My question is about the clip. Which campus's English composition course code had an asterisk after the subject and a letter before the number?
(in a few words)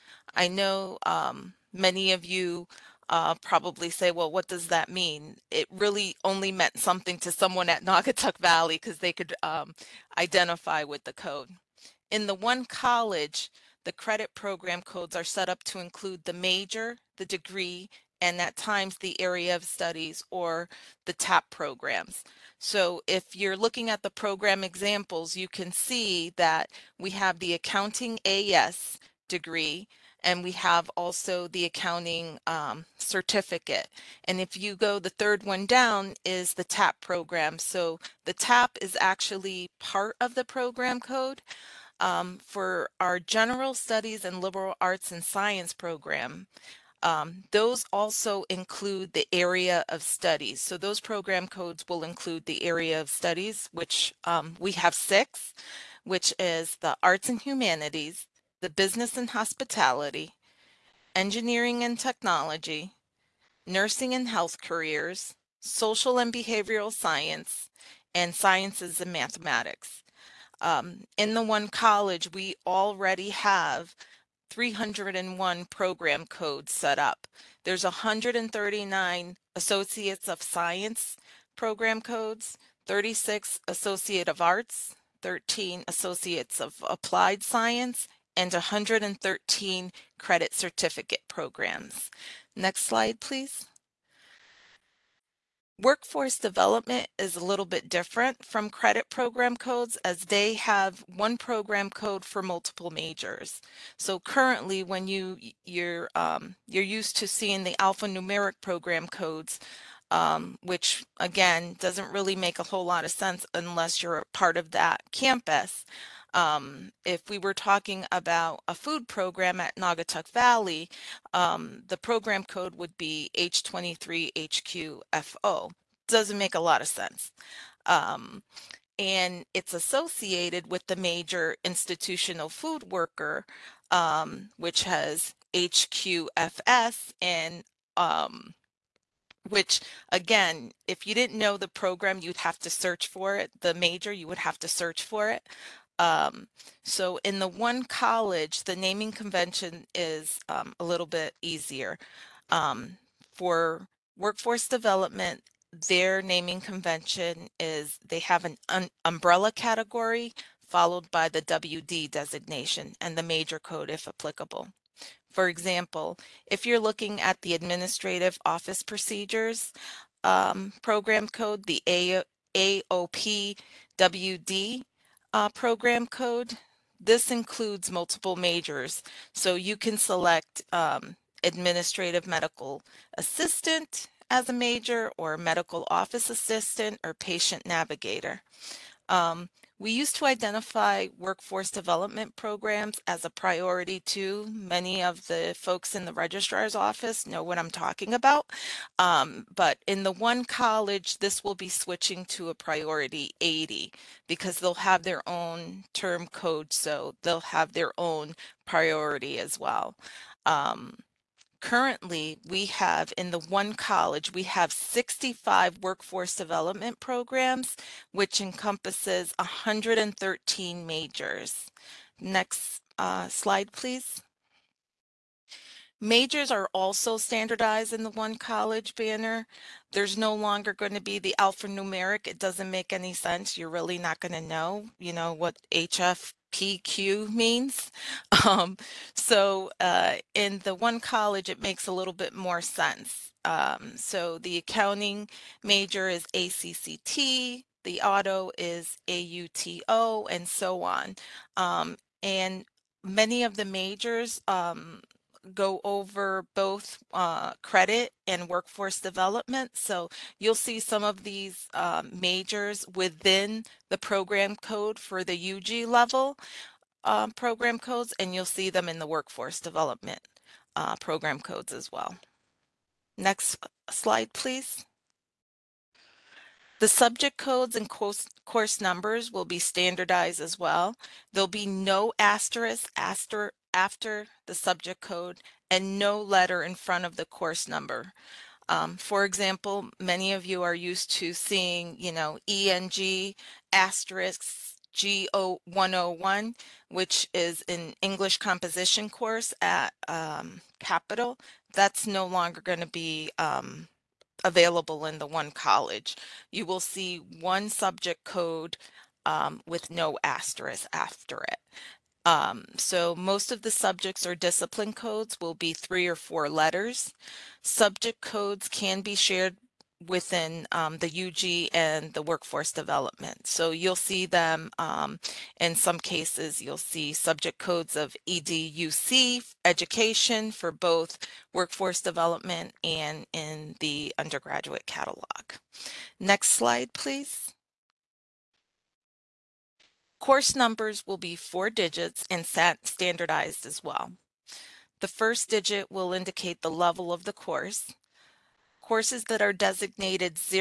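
Capital.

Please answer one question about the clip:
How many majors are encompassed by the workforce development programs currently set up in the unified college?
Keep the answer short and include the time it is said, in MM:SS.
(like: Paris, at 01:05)
113, at 03:39.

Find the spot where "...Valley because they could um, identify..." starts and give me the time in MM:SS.
00:08.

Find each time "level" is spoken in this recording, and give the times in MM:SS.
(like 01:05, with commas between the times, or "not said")
04:25, 05:46.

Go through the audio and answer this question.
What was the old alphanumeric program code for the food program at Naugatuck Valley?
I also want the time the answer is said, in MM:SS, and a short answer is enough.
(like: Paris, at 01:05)
H23HQFO, at 02:03.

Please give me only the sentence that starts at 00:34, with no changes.
And if you go the third one down is the TAP program.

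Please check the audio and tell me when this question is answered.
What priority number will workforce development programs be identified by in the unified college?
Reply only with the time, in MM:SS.
03:23.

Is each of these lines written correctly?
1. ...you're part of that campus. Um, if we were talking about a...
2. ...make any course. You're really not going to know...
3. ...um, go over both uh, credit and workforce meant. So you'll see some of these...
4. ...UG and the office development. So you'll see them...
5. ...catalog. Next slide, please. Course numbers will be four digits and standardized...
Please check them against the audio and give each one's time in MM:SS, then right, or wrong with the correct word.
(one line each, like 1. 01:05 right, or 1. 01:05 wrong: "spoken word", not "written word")
1. 01:54 right
2. 03:52 wrong: "sense", not "course"
3. 04:14 wrong: "development", not "meant"
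4. 05:21 wrong: "workforce", not "office"
5. 05:34 right.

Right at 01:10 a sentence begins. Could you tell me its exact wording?
Um, in the one college, we already have 301 program codes set up.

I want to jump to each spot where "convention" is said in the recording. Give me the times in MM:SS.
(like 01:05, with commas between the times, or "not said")
02:29, 02:36.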